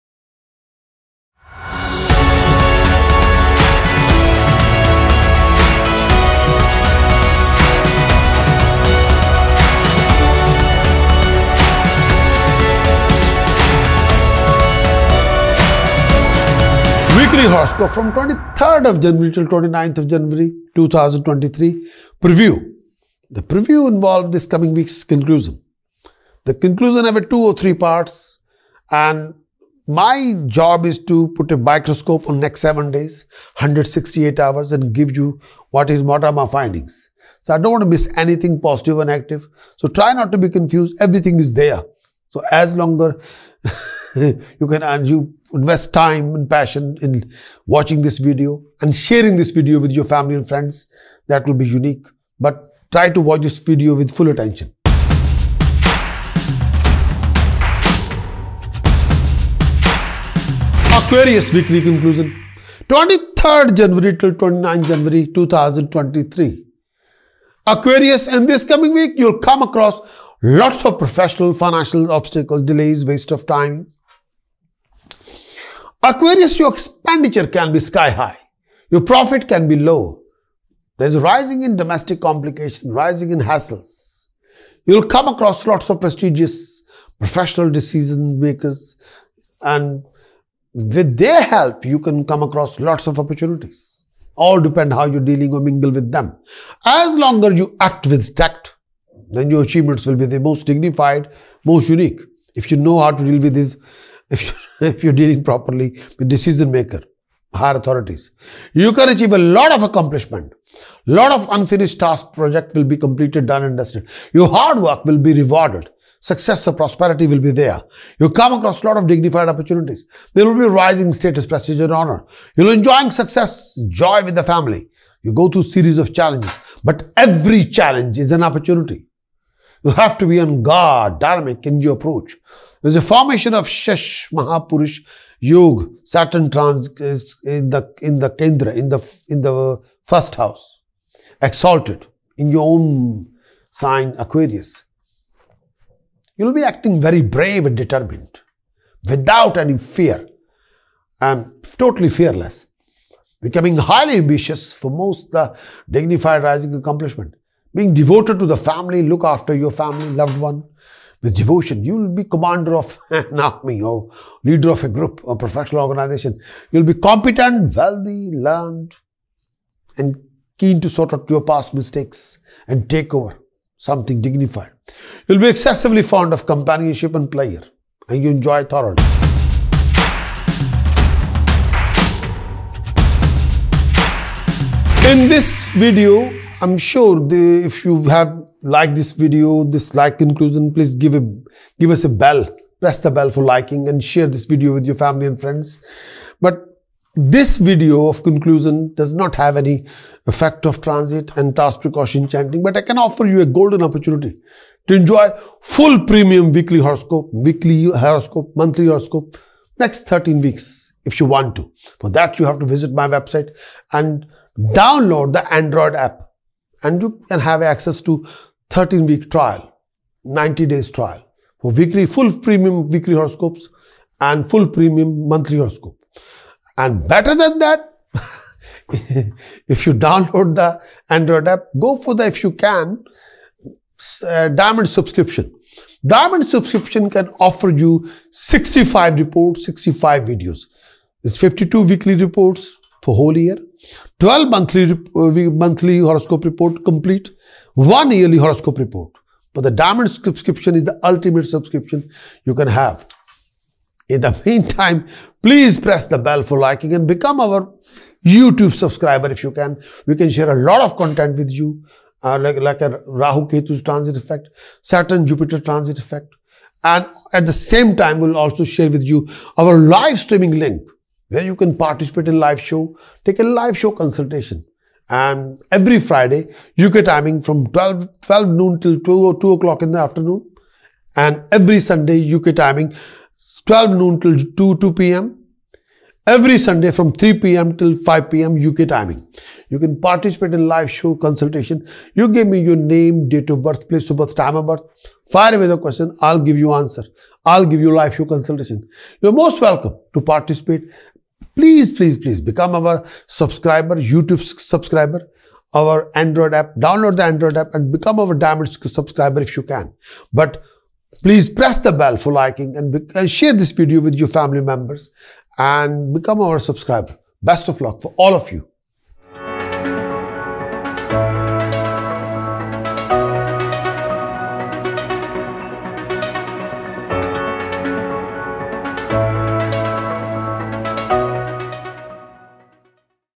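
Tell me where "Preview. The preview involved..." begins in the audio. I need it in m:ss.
0:22.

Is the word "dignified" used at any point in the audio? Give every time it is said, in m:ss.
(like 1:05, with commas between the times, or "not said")
1:40, 1:59, 2:35, 2:54.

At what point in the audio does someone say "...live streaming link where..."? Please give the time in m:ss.
4:29.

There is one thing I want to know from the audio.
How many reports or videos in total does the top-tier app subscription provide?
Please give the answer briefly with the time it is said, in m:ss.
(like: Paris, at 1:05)
65, at 3:58.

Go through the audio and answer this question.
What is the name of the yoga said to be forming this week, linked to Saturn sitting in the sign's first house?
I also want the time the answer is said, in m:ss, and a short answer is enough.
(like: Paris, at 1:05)
Shesh Mahapurush Yoga, at 2:13.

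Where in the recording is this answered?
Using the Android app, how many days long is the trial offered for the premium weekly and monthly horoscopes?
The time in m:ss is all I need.
3:40.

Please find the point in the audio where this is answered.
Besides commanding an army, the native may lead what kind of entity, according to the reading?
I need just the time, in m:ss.
2:45.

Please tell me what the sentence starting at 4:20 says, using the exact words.
We can share a lot of content with you, uh, like, like a Rahu Ketu transit effect, Saturn Jupiter transit effect.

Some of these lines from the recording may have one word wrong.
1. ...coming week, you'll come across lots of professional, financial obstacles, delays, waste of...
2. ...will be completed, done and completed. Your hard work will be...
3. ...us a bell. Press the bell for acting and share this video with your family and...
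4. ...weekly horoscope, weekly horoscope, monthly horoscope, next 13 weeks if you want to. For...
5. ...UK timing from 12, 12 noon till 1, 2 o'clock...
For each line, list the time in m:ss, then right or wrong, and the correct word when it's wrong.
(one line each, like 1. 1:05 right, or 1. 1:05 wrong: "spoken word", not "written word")
1. 1:08 right
2. 1:52 wrong: "dusted", not "completed"
3. 3:11 wrong: "liking", not "acting"
4. 3:26 right
5. 4:36 wrong: "2", not "1".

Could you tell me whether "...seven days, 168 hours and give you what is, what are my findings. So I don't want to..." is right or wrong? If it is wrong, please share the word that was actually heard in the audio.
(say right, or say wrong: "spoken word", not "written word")
right.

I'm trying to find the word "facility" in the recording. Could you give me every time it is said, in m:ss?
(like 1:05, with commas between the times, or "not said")
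not said.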